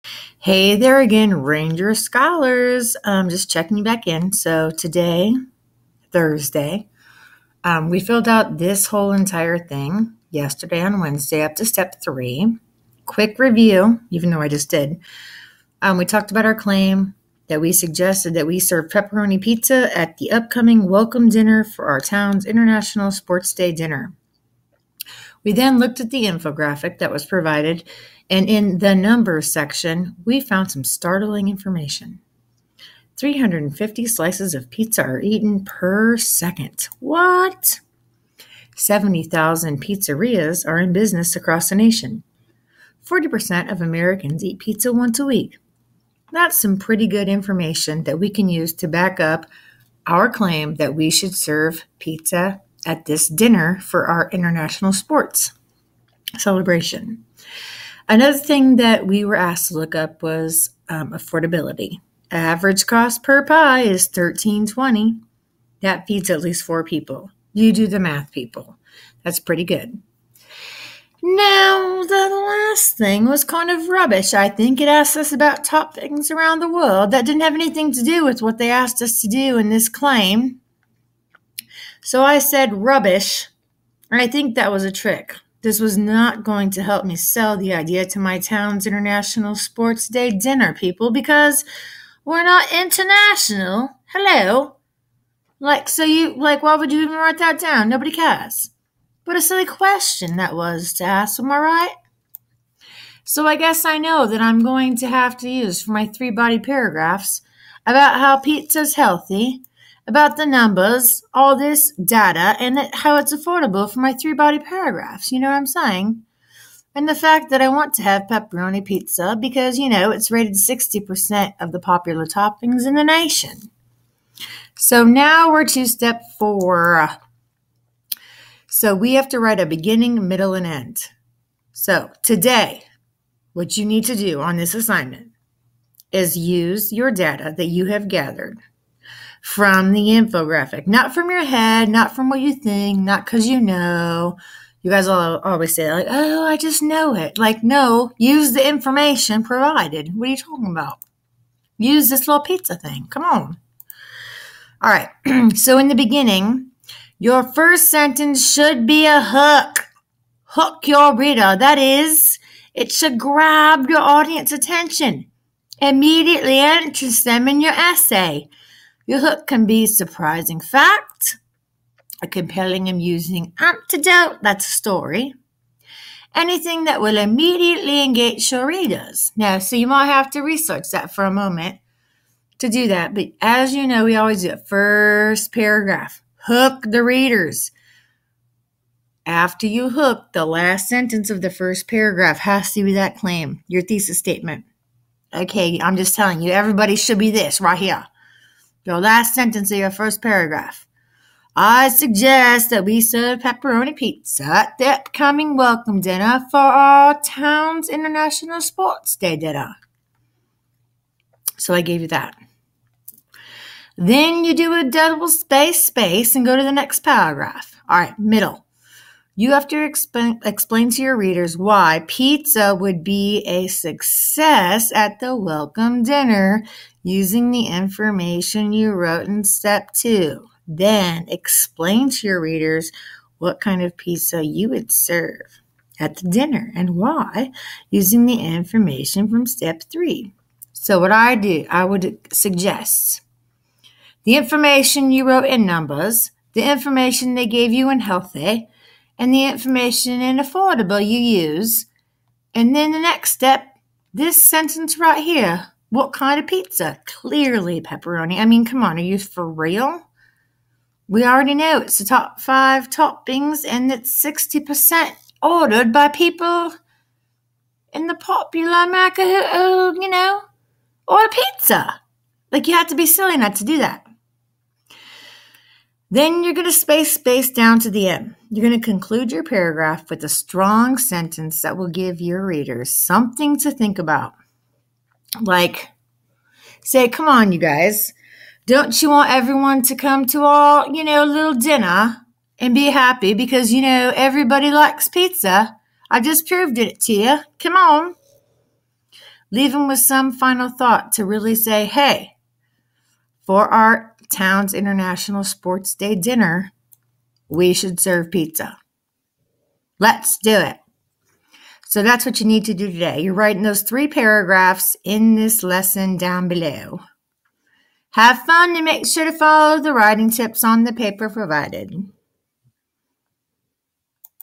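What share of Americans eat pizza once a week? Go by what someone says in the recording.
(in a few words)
40%.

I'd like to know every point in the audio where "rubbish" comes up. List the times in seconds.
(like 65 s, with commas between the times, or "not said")
73 s, 82 s.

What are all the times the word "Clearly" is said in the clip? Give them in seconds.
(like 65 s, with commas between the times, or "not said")
257 s.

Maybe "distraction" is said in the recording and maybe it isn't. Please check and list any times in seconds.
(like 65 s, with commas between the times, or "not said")
not said.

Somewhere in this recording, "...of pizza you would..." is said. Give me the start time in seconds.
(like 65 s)
233 s.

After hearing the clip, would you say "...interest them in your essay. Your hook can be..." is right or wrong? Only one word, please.
right.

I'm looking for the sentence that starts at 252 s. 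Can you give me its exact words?
And then the next step, this sentence right here.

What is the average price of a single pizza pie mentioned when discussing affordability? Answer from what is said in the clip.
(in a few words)
$13.20.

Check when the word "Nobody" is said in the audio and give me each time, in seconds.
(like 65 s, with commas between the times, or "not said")
97 s.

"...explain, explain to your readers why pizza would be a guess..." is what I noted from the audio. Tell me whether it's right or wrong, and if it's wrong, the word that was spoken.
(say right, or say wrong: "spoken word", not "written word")
wrong: "success", not "guess".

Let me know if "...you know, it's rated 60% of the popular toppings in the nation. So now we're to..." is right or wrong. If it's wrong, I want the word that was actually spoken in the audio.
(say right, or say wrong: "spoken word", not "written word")
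right.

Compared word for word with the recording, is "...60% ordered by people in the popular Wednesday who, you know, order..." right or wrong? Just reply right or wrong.
wrong.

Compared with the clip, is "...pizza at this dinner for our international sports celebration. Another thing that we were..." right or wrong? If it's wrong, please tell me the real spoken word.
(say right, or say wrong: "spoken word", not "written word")
right.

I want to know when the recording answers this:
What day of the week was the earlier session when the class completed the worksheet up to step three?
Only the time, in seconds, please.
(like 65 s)
10 s.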